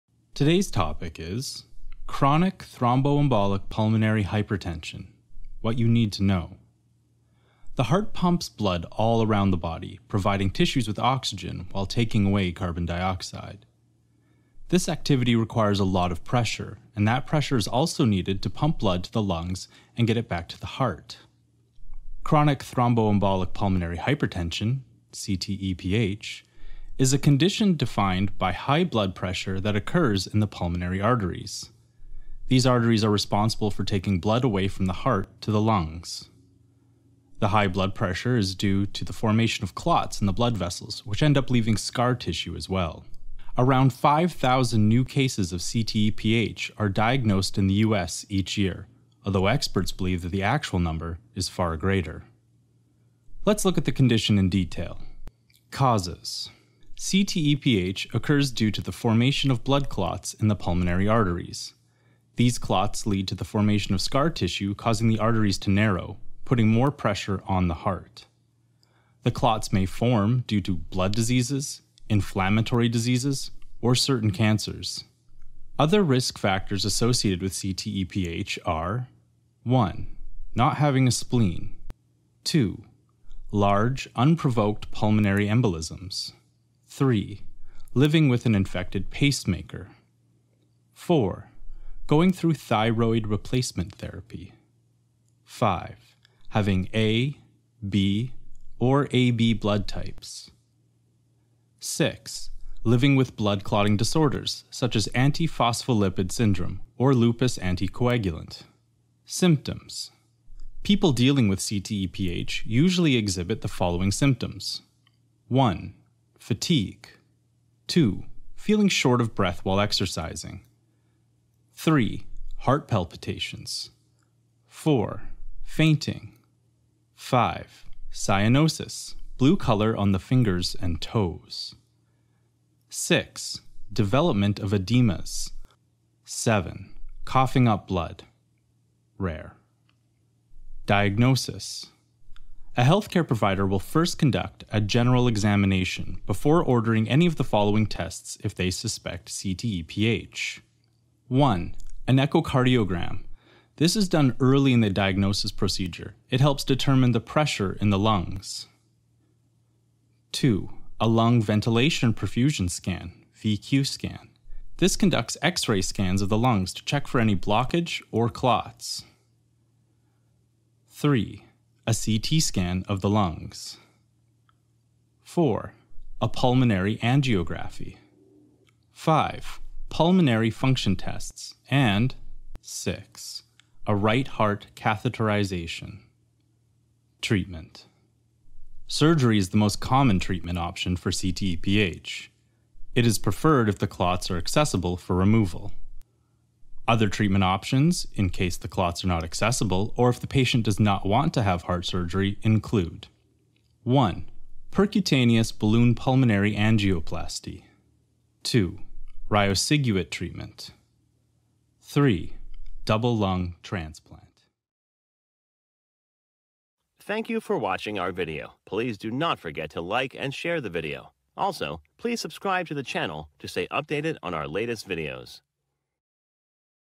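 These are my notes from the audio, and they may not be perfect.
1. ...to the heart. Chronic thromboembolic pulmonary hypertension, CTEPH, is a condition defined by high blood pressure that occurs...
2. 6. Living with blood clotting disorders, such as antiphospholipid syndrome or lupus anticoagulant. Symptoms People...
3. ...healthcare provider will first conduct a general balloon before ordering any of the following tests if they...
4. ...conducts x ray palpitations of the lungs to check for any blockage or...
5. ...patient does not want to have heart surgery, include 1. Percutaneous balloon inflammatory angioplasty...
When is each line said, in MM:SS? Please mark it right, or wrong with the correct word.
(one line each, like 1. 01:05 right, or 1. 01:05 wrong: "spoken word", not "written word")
1. 00:20 right
2. 01:41 right
3. 02:22 wrong: "examination", not "balloon"
4. 02:44 wrong: "scans", not "palpitations"
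5. 03:20 wrong: "pulmonary", not "inflammatory".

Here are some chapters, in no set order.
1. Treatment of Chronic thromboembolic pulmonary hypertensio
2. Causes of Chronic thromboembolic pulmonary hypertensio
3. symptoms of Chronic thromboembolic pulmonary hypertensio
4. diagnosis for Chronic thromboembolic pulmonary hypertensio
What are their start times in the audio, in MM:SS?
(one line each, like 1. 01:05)
1. 03:07
2. 00:55
3. 01:49
4. 02:21.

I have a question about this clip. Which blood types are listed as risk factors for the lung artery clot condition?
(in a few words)
A, B, or AB.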